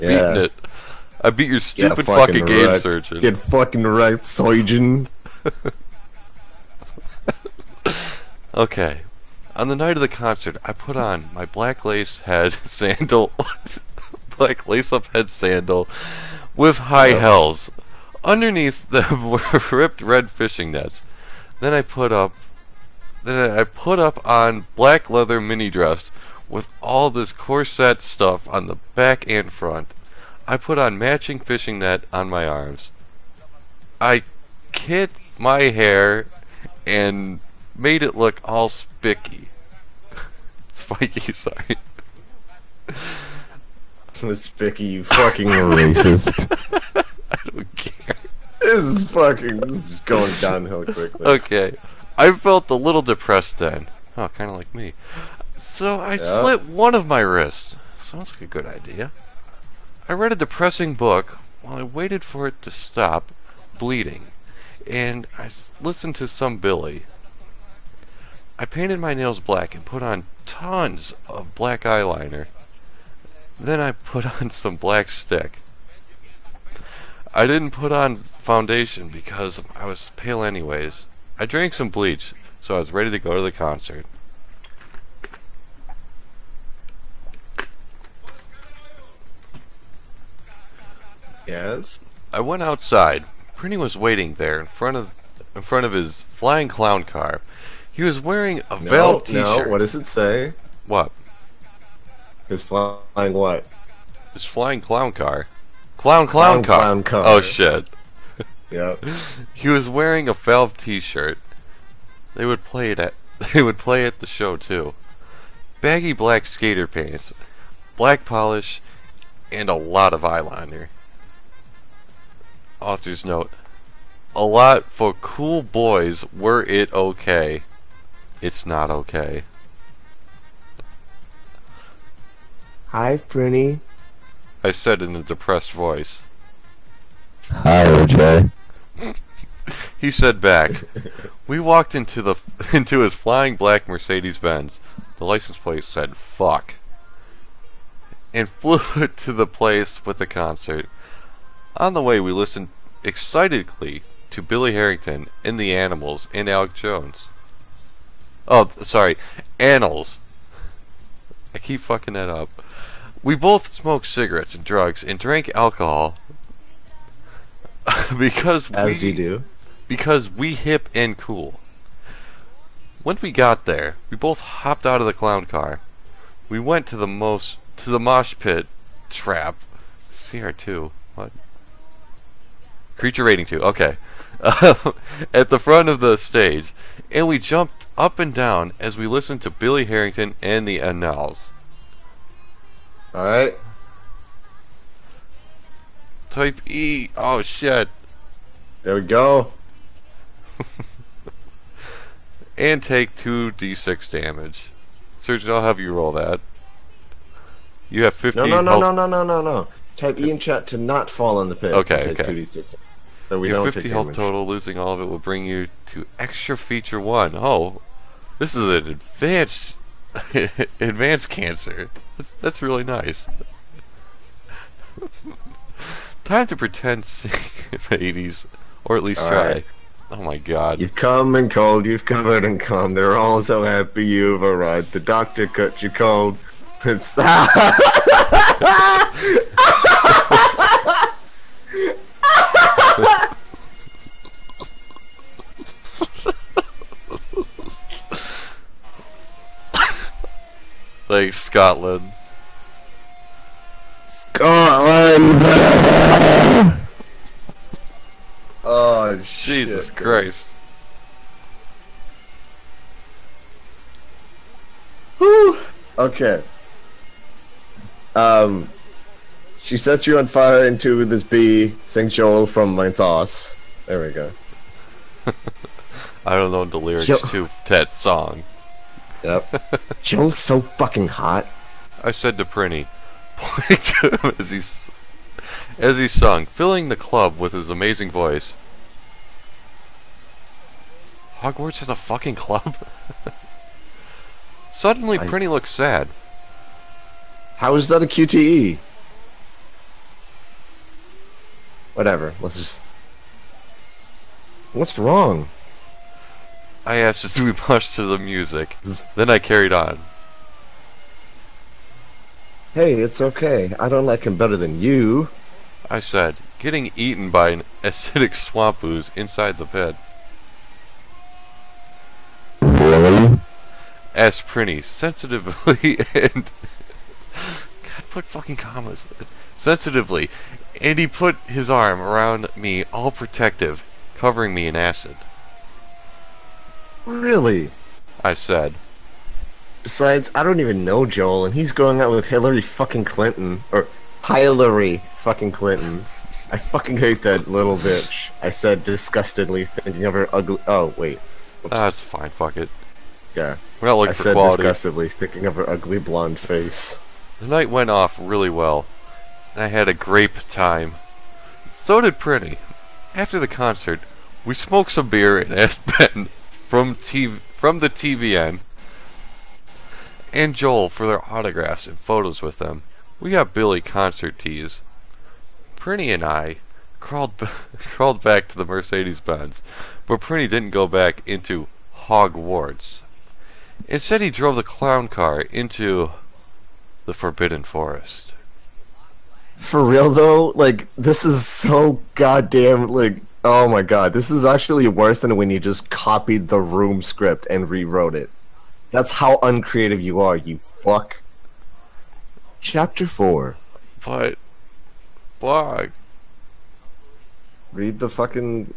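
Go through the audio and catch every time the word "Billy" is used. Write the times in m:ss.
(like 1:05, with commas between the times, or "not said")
1:06, 2:34, 3:09, 6:13.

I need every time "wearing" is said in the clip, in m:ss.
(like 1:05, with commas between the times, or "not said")
1:38, 1:49.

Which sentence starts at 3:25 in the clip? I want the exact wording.
Surgeon, I'll have you roll that.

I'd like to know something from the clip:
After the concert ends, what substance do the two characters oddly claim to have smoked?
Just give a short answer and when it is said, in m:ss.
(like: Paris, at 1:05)
beer, at 6:05.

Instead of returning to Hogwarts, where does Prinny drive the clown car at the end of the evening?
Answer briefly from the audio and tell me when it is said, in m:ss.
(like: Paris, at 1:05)
Forbidden Forest, at 6:27.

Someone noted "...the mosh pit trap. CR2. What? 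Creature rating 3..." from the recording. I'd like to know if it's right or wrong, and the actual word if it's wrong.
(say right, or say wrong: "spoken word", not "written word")
wrong: "2", not "3".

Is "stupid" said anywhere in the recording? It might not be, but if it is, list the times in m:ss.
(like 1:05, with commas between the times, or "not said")
0:01.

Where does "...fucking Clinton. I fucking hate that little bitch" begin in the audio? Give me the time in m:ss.
5:45.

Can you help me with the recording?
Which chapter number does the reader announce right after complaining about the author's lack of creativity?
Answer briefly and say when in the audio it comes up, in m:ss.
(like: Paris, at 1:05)
4, at 6:42.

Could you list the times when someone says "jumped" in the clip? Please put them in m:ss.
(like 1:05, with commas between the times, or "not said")
3:07.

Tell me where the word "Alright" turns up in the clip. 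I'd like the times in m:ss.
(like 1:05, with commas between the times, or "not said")
3:13.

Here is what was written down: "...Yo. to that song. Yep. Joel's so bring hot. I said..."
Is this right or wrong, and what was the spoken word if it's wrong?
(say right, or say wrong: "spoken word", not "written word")
wrong: "fucking", not "bring".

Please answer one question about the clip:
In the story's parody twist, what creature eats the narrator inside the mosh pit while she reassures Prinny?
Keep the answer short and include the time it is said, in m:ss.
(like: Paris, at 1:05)
acidic swamp ooze, at 5:17.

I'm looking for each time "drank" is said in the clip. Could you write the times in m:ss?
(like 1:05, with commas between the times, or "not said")
1:21, 2:45.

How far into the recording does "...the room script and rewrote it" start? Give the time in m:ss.
6:36.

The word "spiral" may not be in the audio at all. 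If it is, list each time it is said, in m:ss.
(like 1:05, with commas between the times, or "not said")
not said.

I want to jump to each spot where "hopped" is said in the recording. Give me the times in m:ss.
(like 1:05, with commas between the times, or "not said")
2:54.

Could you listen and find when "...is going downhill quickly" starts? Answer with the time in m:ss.
0:49.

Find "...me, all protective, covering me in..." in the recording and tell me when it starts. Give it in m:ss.
5:32.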